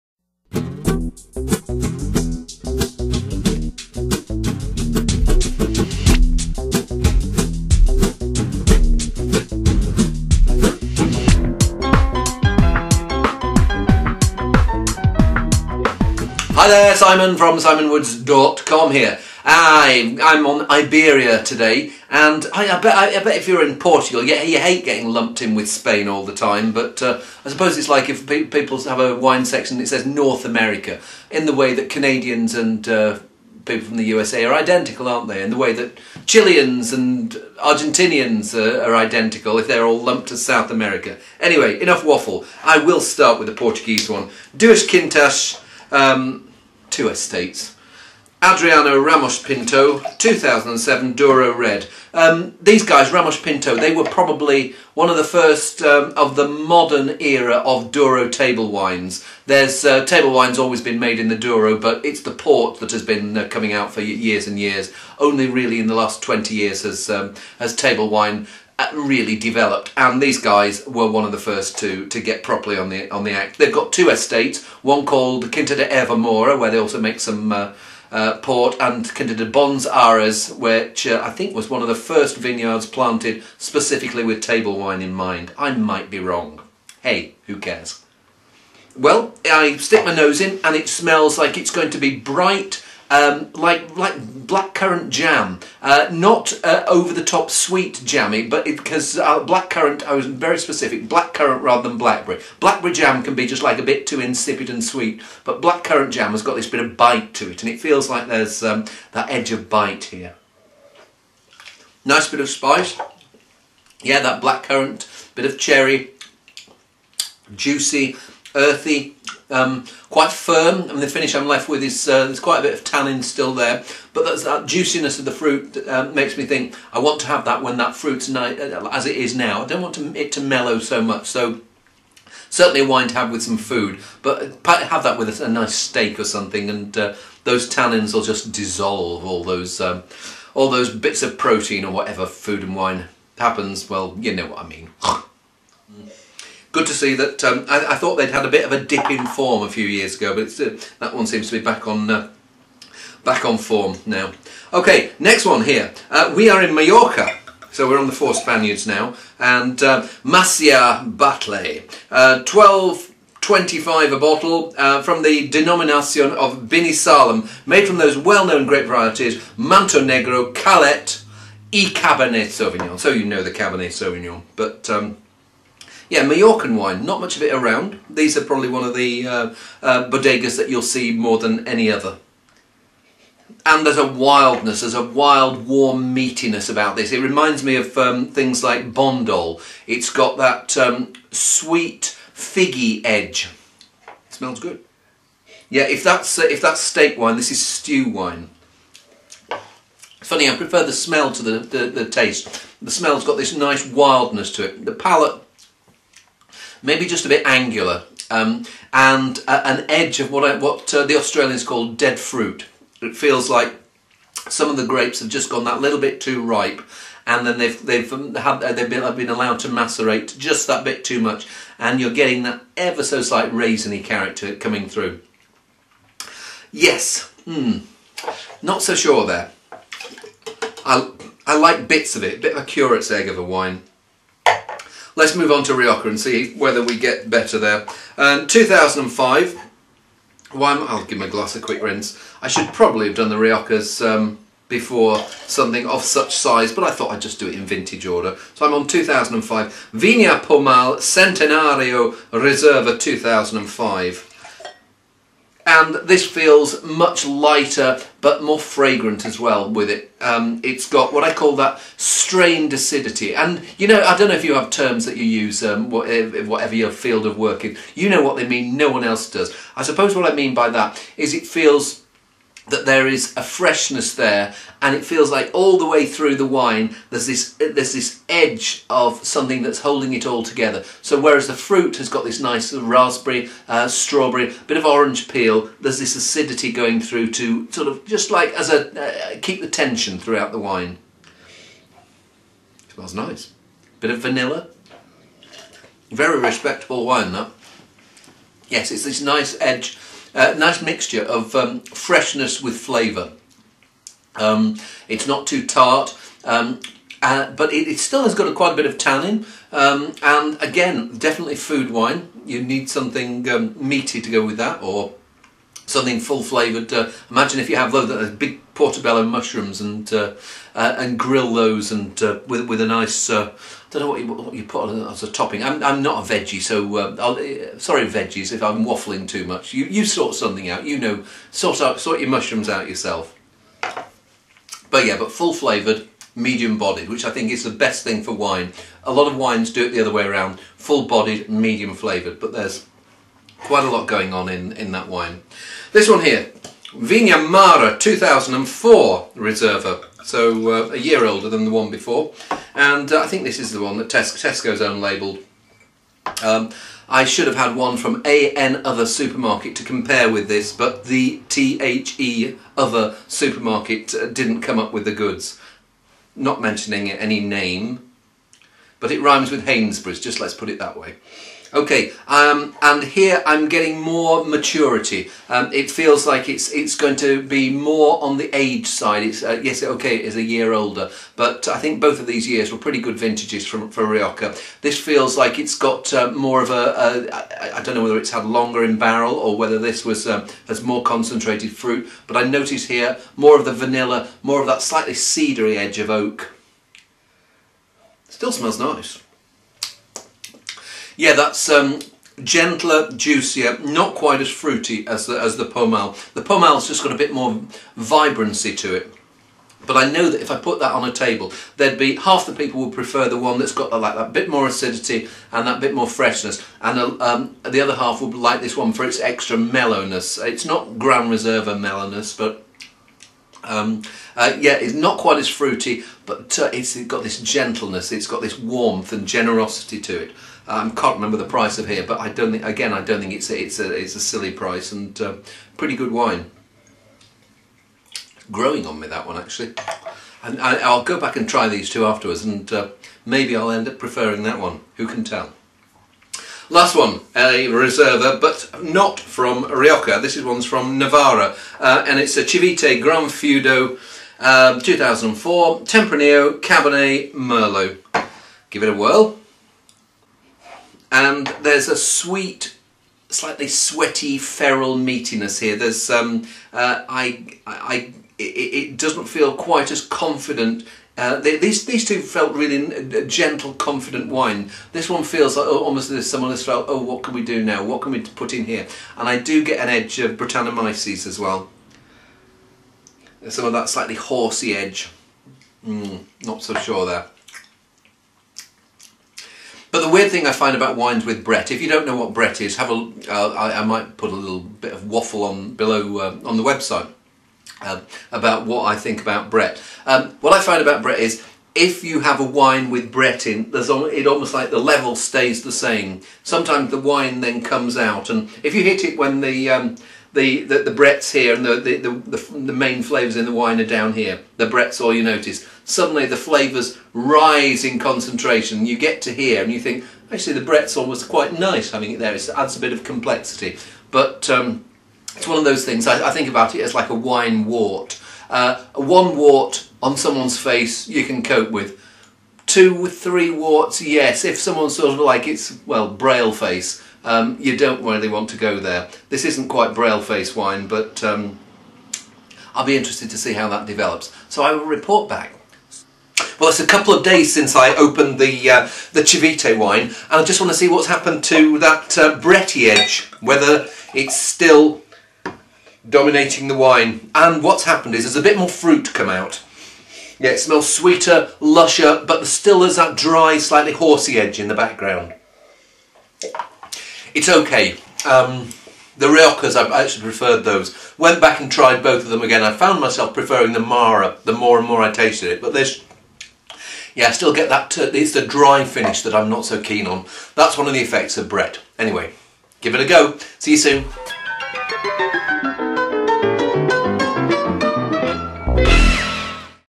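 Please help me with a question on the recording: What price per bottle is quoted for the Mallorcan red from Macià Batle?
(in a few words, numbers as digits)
12.25.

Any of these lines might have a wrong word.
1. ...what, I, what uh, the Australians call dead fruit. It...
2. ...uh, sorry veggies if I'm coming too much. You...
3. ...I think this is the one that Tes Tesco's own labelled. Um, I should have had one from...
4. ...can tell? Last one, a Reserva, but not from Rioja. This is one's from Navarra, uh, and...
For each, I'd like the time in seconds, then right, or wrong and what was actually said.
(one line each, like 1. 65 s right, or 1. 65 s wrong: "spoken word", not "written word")
1. 210 s right
2. 326 s wrong: "waffling", not "coming"
3. 353 s right
4. 445 s right.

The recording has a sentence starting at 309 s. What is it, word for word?
Um, and again, definitely food wine.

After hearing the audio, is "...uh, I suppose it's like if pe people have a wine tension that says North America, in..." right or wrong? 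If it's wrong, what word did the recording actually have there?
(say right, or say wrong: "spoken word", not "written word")
wrong: "section", not "tension".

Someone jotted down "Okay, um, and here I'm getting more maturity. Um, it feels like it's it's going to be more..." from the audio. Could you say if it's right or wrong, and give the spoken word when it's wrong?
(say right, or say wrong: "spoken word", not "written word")
right.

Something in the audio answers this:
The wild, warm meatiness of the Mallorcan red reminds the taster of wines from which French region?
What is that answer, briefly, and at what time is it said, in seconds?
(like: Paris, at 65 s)
Bandol, at 188 s.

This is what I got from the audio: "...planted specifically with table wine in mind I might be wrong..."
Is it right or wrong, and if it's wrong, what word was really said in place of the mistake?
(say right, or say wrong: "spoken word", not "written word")
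right.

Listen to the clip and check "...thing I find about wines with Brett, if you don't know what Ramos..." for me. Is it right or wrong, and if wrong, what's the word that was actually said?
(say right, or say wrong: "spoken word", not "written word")
wrong: "Brett", not "Ramos".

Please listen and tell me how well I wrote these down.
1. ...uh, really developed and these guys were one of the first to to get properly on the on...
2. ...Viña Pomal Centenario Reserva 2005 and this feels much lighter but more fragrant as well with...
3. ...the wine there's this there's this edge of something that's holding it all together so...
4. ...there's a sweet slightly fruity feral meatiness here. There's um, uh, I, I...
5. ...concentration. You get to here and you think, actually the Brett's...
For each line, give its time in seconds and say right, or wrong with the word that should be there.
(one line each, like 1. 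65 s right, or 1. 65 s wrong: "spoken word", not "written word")
1. 68 s right
2. 249 s right
3. 276 s right
4. 461 s wrong: "sweaty", not "fruity"
5. 517 s right.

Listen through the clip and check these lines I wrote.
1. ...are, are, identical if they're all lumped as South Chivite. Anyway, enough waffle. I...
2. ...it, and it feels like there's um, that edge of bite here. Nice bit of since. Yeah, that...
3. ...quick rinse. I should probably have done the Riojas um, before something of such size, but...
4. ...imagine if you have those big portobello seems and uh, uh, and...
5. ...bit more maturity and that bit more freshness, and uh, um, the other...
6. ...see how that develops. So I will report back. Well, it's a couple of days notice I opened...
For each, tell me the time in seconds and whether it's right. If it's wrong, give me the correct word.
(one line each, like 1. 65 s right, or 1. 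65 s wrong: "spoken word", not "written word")
1. 38 s wrong: "America", not "Chivite"
2. 107 s wrong: "spice", not "since"
3. 241 s right
4. 317 s wrong: "mushrooms", not "seems"
5. 414 s wrong: "acidity", not "maturity"
6. 543 s wrong: "since", not "notice".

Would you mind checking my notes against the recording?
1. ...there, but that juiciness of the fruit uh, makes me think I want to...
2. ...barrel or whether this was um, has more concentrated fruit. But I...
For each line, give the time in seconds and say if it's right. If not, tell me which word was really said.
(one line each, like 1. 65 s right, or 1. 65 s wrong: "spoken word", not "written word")
1. 123 s right
2. 388 s right.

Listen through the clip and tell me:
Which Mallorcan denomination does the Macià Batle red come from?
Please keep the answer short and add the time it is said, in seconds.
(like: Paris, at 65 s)
Binisalem, at 166 s.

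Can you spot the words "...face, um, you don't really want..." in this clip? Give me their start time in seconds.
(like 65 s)
536 s.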